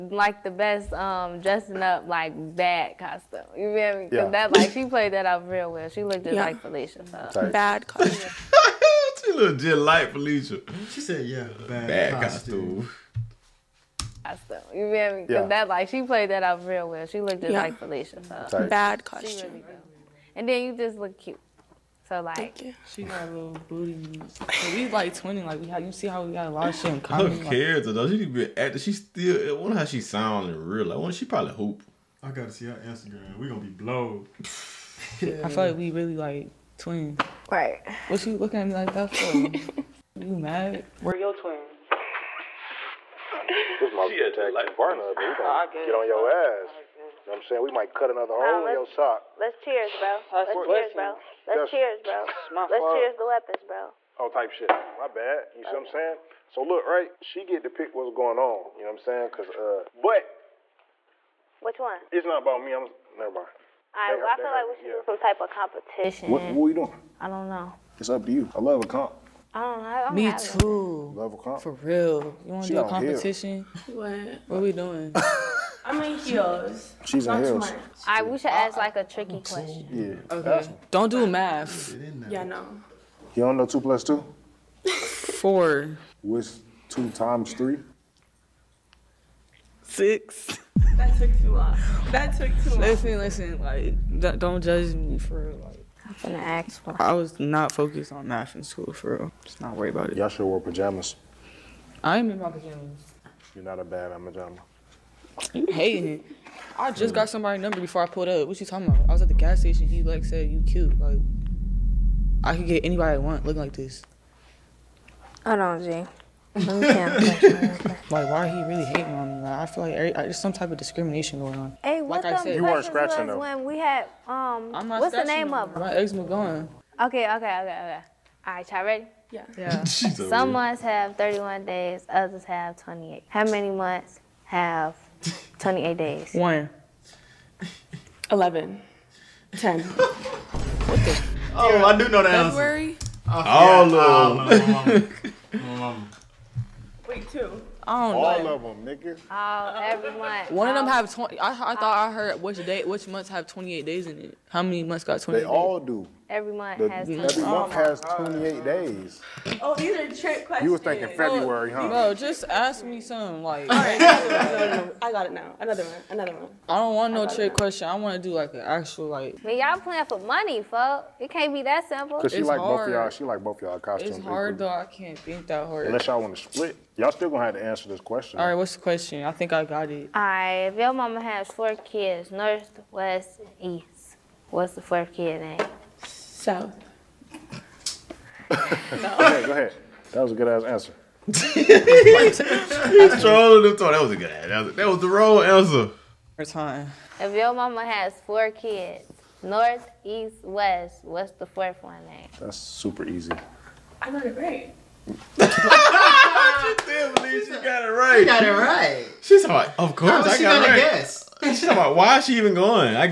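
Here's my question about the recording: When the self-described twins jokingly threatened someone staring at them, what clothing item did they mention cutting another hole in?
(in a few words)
sock.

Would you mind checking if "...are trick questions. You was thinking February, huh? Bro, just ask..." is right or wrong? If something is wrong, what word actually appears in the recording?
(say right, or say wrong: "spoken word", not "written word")
right.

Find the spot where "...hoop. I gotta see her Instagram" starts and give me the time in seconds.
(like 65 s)
31 s.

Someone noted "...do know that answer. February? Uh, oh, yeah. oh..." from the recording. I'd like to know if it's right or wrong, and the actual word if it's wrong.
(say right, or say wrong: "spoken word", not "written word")
right.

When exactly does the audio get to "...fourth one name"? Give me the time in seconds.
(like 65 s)
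201 s.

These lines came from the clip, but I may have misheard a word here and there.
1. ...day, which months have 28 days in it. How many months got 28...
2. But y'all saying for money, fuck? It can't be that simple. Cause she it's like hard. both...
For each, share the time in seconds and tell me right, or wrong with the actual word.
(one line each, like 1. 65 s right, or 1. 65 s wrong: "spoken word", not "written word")
1. 152 s right
2. 169 s wrong: "playing", not "saying".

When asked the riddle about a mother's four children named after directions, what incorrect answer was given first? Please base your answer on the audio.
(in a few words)
South.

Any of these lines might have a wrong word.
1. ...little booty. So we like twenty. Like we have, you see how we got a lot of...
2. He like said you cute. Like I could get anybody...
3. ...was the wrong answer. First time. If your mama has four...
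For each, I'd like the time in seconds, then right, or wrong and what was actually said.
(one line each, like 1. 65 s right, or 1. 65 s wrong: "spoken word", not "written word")
1. 23 s right
2. 109 s right
3. 194 s right.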